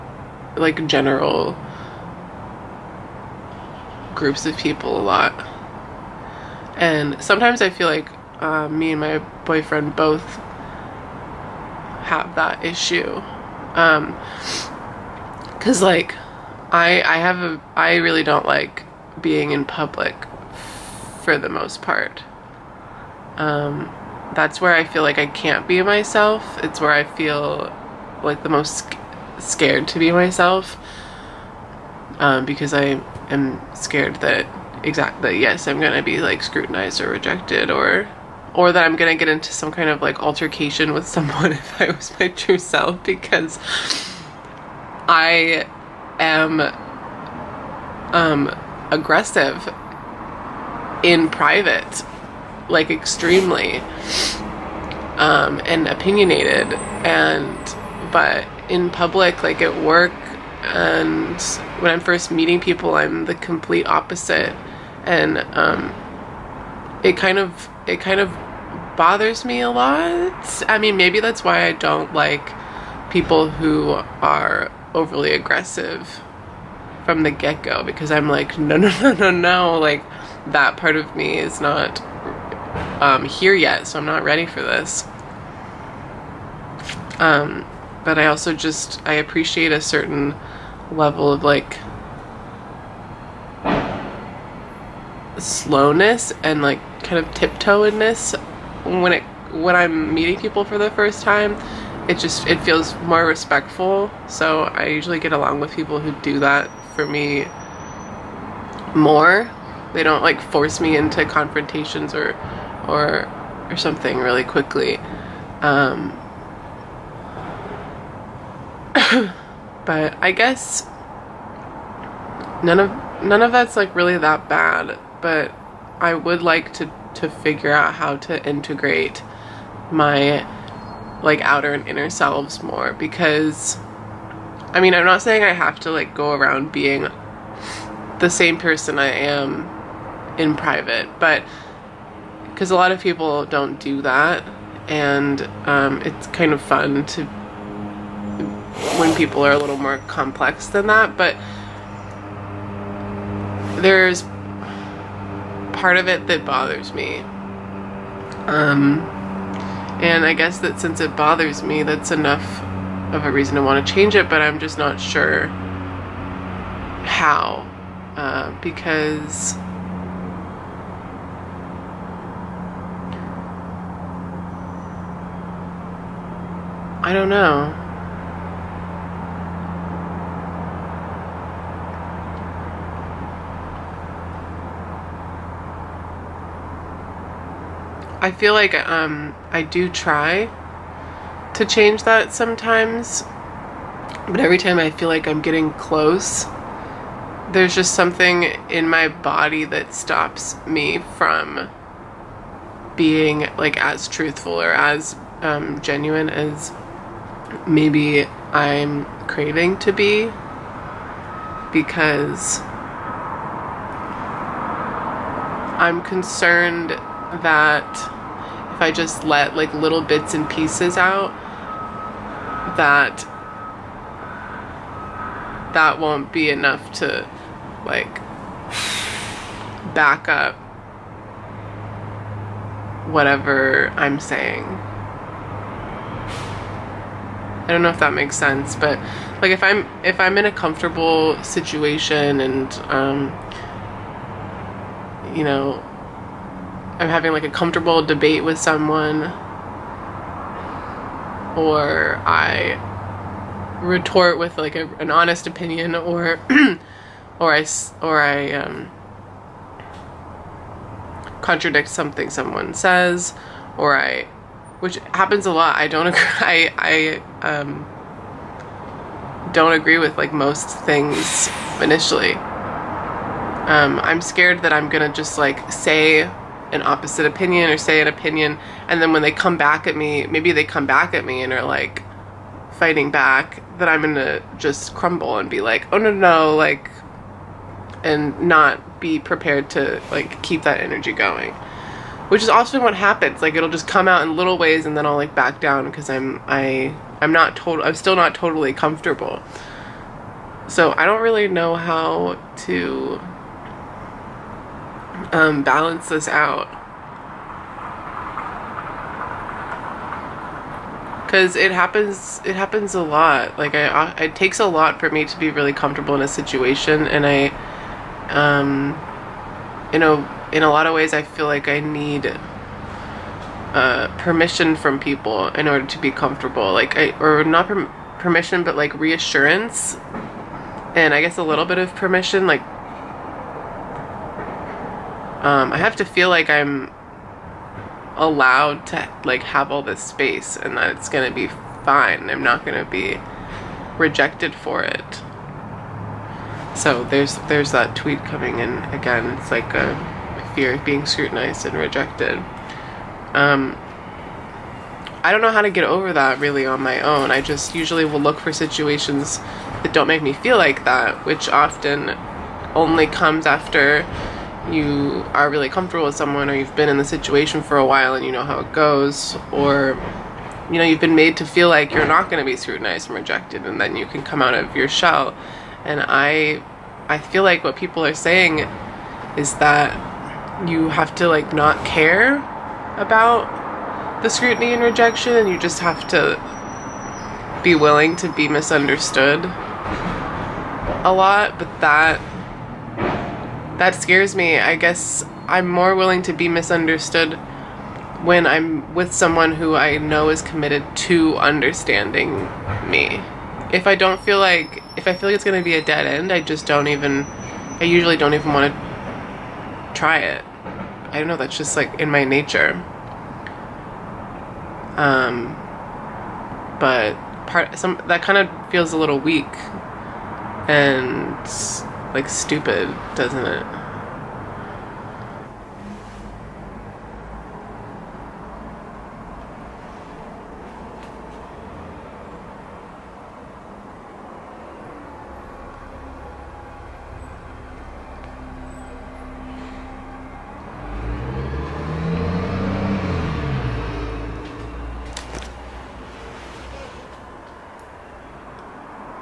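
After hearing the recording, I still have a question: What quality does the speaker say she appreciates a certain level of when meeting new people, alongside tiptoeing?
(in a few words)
slowness.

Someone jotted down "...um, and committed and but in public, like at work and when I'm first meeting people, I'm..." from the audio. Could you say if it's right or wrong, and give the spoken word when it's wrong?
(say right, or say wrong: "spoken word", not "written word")
wrong: "opinionated", not "committed".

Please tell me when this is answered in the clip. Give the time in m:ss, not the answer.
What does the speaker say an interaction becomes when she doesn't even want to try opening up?
6:45.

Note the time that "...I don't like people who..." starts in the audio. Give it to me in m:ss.
1:11.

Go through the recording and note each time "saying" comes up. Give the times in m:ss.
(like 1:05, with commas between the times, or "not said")
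2:15, 3:54, 6:18.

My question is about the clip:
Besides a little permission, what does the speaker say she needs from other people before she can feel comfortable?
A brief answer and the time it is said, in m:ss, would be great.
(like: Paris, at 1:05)
reassurance, at 5:28.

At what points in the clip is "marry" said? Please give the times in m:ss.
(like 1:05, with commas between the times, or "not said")
not said.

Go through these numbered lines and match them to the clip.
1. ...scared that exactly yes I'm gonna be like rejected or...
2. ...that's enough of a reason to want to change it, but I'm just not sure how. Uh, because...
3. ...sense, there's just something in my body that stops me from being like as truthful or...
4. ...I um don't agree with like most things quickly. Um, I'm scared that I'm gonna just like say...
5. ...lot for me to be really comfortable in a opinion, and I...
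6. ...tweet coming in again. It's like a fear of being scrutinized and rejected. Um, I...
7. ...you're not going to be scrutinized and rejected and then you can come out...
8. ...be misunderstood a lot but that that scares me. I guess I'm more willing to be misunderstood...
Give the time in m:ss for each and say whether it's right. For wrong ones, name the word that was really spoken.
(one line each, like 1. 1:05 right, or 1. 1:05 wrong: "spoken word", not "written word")
1. 0:33 wrong: "scrutinized", not "rejected"
2. 2:41 right
3. 3:15 wrong: "close", not "sense"
4. 4:26 wrong: "initially", not "quickly"
5. 5:14 wrong: "situation", not "opinion"
6. 5:47 right
7. 6:11 right
8. 6:28 right.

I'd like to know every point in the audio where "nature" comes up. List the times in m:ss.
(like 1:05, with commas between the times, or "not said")
6:52.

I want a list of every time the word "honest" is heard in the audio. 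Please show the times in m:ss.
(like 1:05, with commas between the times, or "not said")
4:15.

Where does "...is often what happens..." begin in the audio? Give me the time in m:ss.
4:52.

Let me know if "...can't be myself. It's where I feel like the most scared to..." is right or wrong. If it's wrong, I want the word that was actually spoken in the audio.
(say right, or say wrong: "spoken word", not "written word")
right.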